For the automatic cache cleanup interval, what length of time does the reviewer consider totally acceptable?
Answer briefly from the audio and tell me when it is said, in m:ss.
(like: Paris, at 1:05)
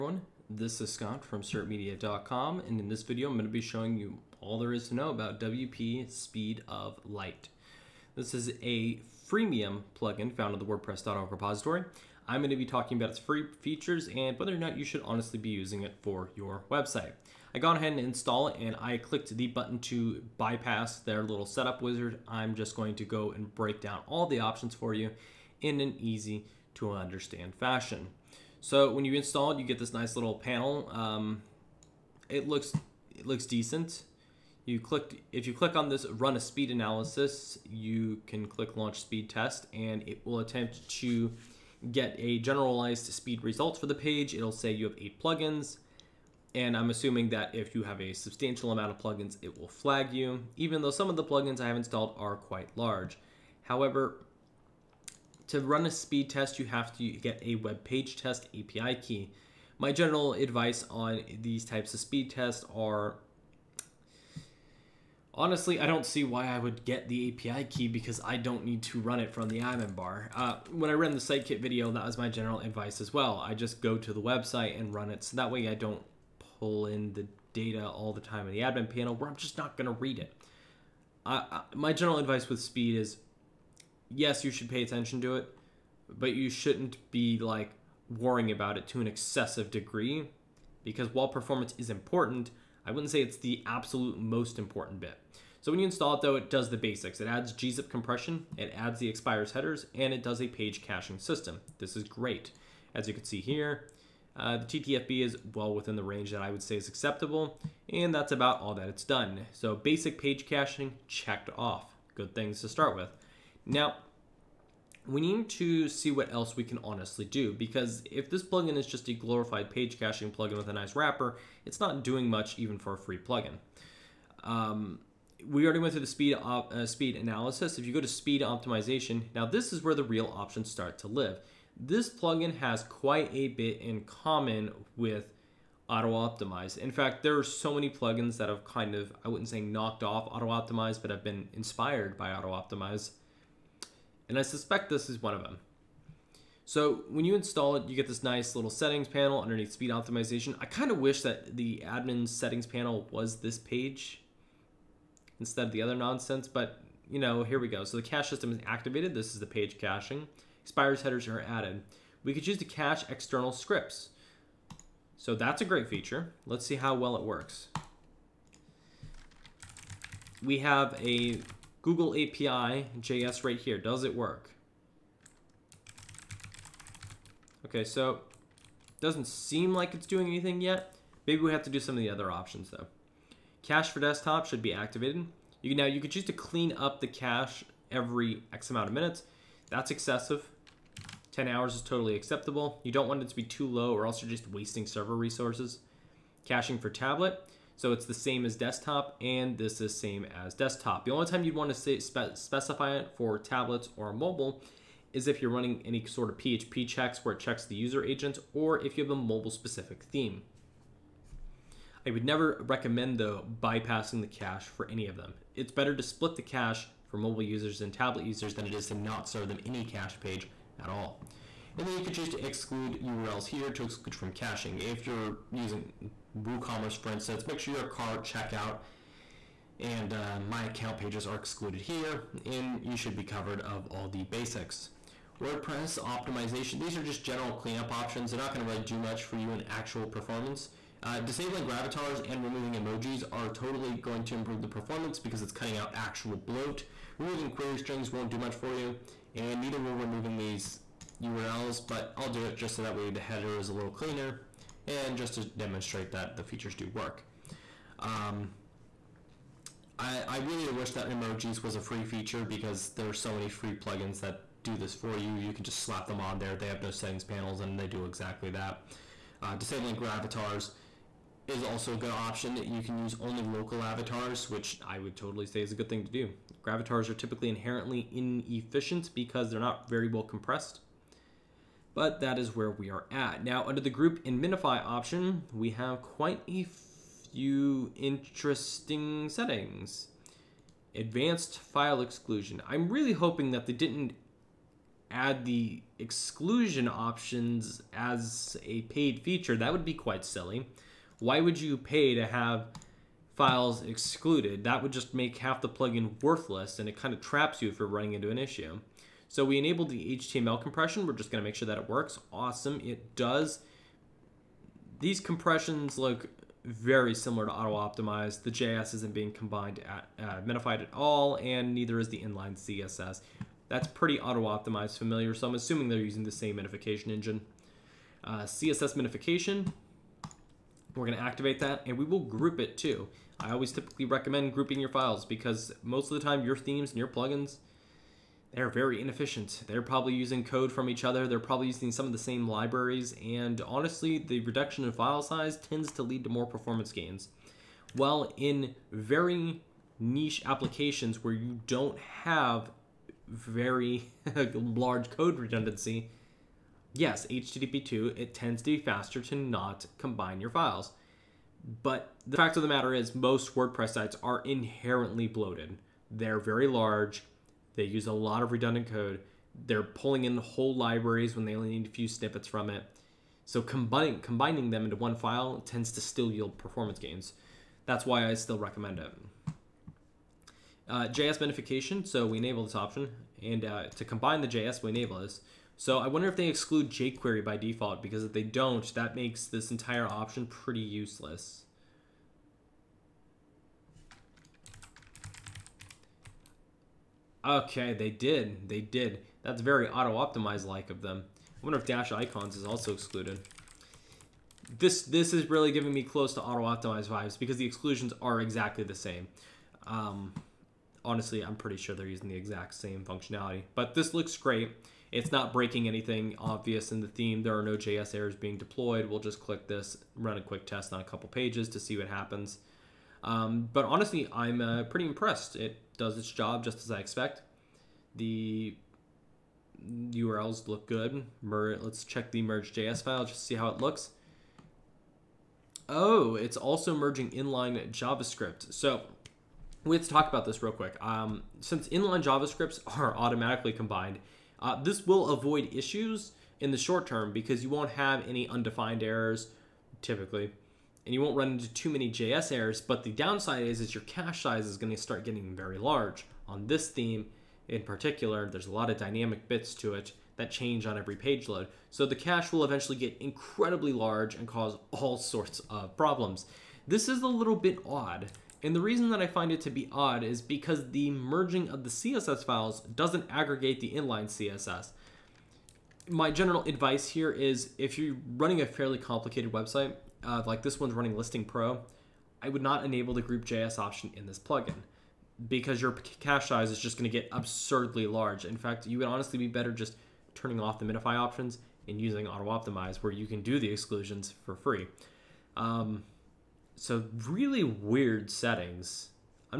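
10 hours, at 3:11.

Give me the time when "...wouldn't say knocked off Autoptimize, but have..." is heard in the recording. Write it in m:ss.
2:19.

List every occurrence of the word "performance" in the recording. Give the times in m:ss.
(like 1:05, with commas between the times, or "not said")
1:31, 4:00, 4:04, 5:46, 6:16.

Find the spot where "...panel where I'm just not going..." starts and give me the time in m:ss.
1:18.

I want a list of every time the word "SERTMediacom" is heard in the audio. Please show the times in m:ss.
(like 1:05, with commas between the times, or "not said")
0:01.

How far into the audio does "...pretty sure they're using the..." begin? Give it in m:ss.
6:51.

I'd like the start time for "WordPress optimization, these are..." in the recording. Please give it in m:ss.
3:55.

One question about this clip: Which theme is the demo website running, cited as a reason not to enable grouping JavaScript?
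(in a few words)
ListingPro.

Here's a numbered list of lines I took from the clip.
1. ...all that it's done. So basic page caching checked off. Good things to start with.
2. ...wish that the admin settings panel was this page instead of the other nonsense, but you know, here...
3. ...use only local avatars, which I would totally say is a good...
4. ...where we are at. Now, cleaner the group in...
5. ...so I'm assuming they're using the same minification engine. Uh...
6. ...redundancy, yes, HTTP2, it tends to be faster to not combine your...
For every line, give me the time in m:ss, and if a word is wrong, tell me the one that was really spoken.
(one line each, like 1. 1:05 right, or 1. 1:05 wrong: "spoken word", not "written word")
1. 1:48 right
2. 2:30 right
3. 4:32 right
4. 4:42 wrong: "under", not "cleaner"
5. 5:25 right
6. 5:55 right.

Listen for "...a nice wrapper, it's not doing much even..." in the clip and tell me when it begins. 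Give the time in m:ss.
2:00.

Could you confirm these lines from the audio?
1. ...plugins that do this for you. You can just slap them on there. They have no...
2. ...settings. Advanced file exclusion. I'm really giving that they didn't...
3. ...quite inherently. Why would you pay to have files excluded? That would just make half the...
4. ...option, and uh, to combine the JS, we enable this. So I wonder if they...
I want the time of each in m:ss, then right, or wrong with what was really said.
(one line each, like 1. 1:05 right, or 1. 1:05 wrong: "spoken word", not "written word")
1. 4:23 right
2. 4:49 wrong: "hoping", not "giving"
3. 4:59 wrong: "silly", not "inherently"
4. 6:22 right.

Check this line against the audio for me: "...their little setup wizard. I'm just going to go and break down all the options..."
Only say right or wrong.
right.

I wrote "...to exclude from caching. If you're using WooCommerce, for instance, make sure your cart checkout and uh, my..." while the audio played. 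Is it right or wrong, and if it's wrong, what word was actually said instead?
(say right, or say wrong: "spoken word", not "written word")
right.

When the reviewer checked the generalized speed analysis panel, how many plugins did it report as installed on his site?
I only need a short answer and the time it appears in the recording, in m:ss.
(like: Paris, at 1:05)
8, at 0:44.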